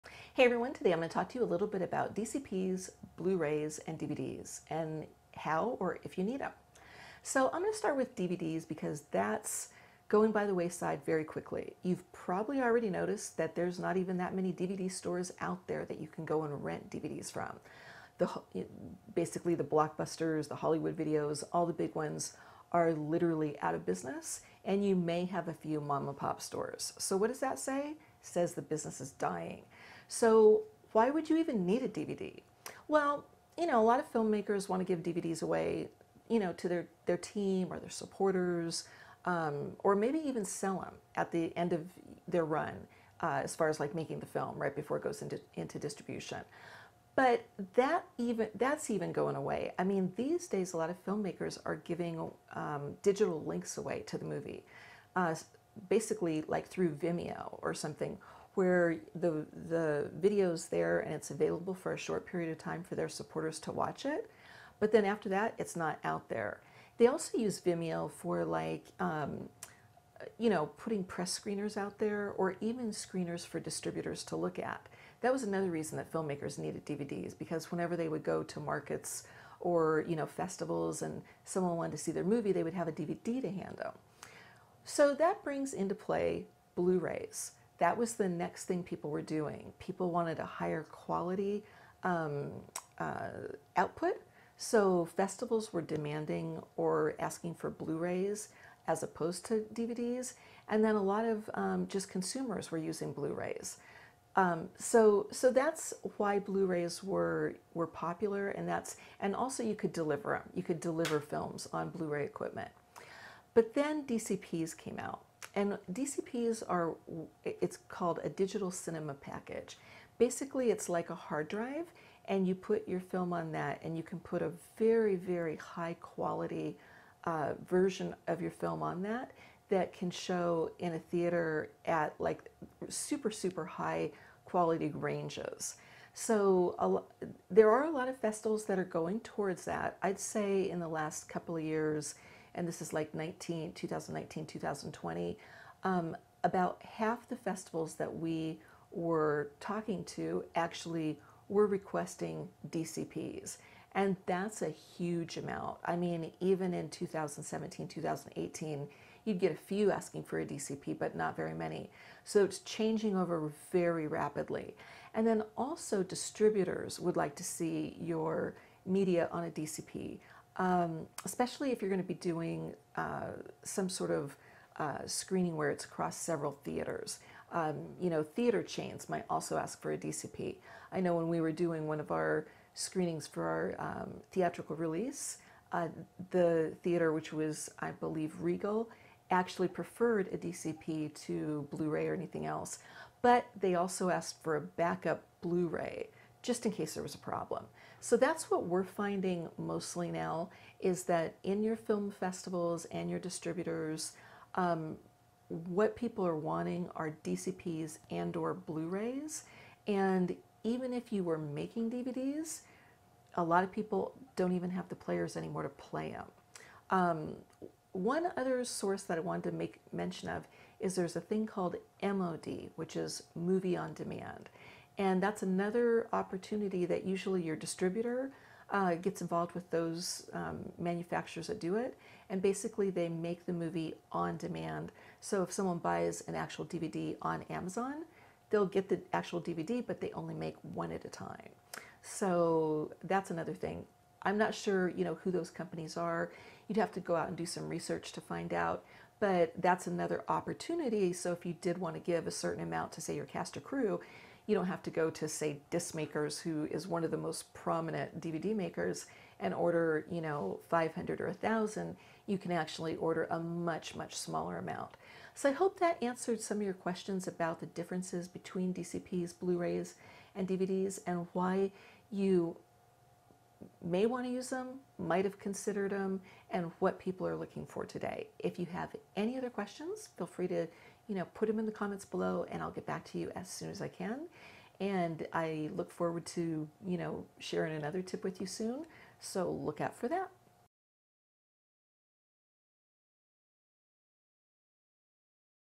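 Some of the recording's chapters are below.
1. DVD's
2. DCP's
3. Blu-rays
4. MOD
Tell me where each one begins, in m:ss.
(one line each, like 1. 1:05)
1. 0:12
2. 1:58
3. 3:21
4. 3:47.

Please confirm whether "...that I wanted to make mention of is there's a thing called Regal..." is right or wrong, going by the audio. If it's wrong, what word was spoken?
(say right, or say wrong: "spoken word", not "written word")
wrong: "MOD", not "Regal".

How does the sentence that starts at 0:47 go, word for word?
But that even that's even going away.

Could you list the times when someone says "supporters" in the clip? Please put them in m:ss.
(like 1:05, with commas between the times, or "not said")
0:37, 1:03.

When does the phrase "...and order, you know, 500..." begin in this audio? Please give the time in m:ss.
4:19.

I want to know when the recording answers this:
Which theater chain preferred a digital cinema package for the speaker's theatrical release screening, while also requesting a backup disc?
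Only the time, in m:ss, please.
3:08.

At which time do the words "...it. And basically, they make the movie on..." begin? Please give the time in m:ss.
3:51.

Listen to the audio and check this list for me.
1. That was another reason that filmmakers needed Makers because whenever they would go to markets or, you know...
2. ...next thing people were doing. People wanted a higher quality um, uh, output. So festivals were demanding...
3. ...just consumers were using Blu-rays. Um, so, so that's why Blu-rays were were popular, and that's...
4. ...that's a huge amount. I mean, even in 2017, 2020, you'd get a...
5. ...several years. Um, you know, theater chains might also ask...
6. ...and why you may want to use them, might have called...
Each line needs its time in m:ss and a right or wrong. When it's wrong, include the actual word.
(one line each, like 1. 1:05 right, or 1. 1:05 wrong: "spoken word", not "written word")
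1. 1:15 wrong: "DVDs", not "Makers"
2. 1:28 right
3. 1:41 right
4. 2:34 wrong: "2018", not "2020"
5. 2:56 wrong: "theaters", not "years"
6. 4:31 wrong: "considered", not "called".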